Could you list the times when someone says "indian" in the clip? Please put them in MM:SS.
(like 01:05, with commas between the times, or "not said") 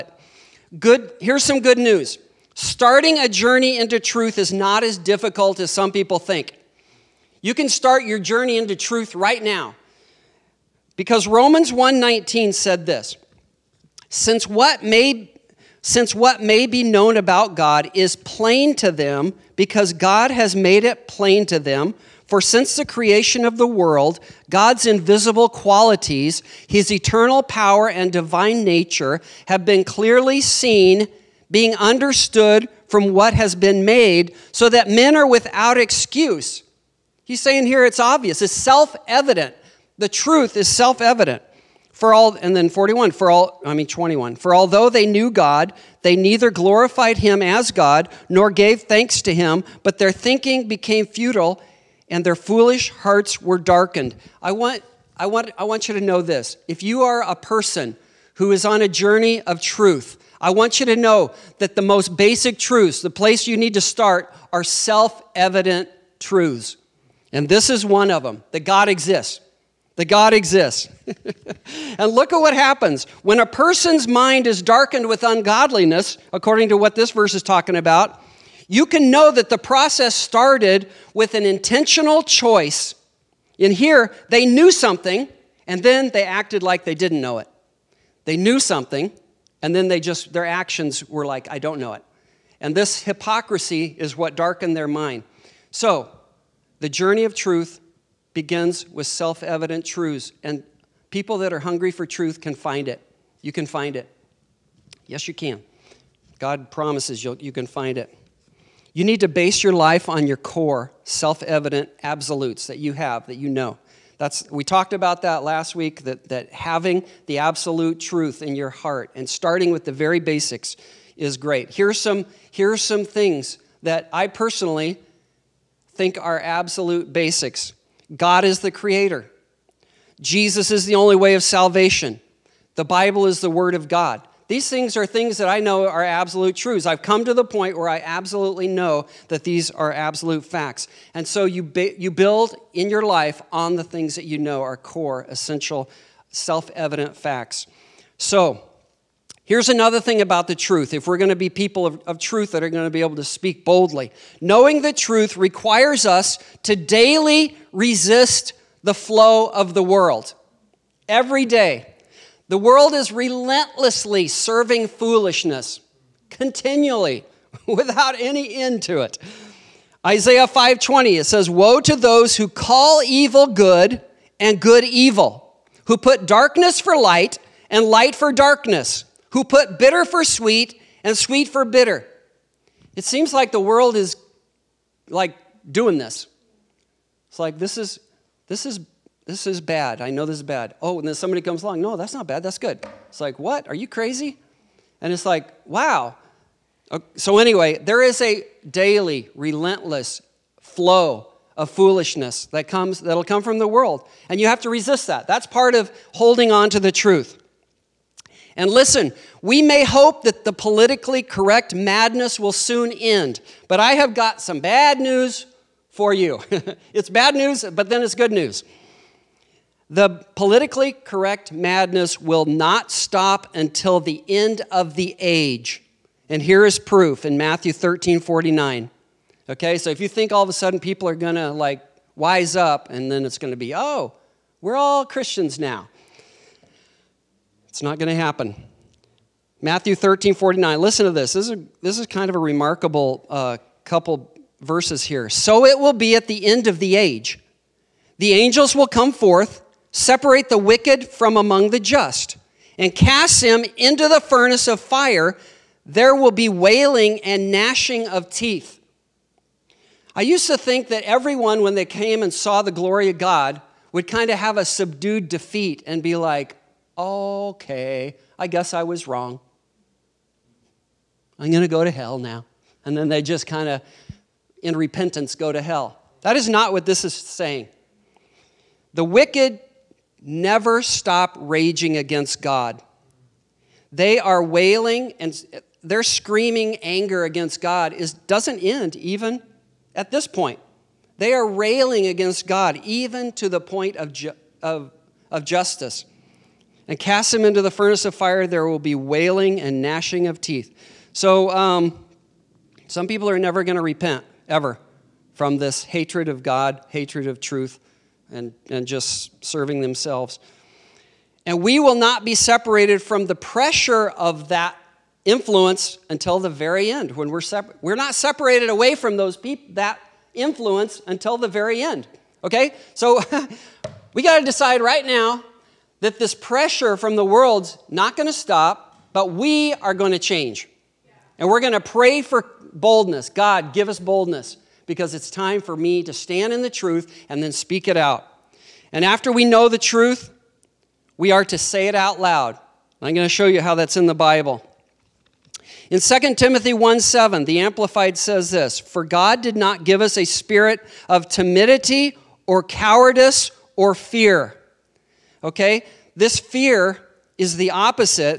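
not said.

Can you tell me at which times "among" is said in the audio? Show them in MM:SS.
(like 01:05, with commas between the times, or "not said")
04:11.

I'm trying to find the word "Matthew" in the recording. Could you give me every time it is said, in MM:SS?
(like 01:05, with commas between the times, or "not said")
03:47, 03:59.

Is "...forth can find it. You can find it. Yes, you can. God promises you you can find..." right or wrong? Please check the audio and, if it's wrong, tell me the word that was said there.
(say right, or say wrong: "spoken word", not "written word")
wrong: "truth", not "forth".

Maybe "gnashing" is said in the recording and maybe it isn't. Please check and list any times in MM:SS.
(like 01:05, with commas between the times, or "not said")
04:17, 04:59.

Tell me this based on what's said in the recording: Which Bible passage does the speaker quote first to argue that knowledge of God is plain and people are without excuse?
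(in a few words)
Romans 1:19.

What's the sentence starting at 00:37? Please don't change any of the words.
He's saying here it's obvious, it's self evident.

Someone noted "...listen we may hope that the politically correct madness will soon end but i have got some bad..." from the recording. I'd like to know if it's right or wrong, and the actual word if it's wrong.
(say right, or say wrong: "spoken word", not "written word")
right.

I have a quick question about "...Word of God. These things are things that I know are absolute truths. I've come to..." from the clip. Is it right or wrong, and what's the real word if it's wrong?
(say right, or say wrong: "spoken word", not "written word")
right.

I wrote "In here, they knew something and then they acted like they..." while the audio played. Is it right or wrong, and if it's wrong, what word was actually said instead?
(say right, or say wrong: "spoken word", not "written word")
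right.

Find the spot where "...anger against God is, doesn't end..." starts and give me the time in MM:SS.
04:46.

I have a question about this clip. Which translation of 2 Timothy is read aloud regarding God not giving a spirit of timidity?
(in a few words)
Amplified.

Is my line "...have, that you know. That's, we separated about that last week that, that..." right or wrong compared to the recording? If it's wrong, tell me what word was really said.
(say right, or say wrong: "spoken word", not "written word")
wrong: "talked", not "separated".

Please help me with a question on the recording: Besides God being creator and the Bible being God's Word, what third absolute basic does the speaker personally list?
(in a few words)
Jesus is the only way of salvation.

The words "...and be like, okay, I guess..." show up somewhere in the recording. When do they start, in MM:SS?
04:25.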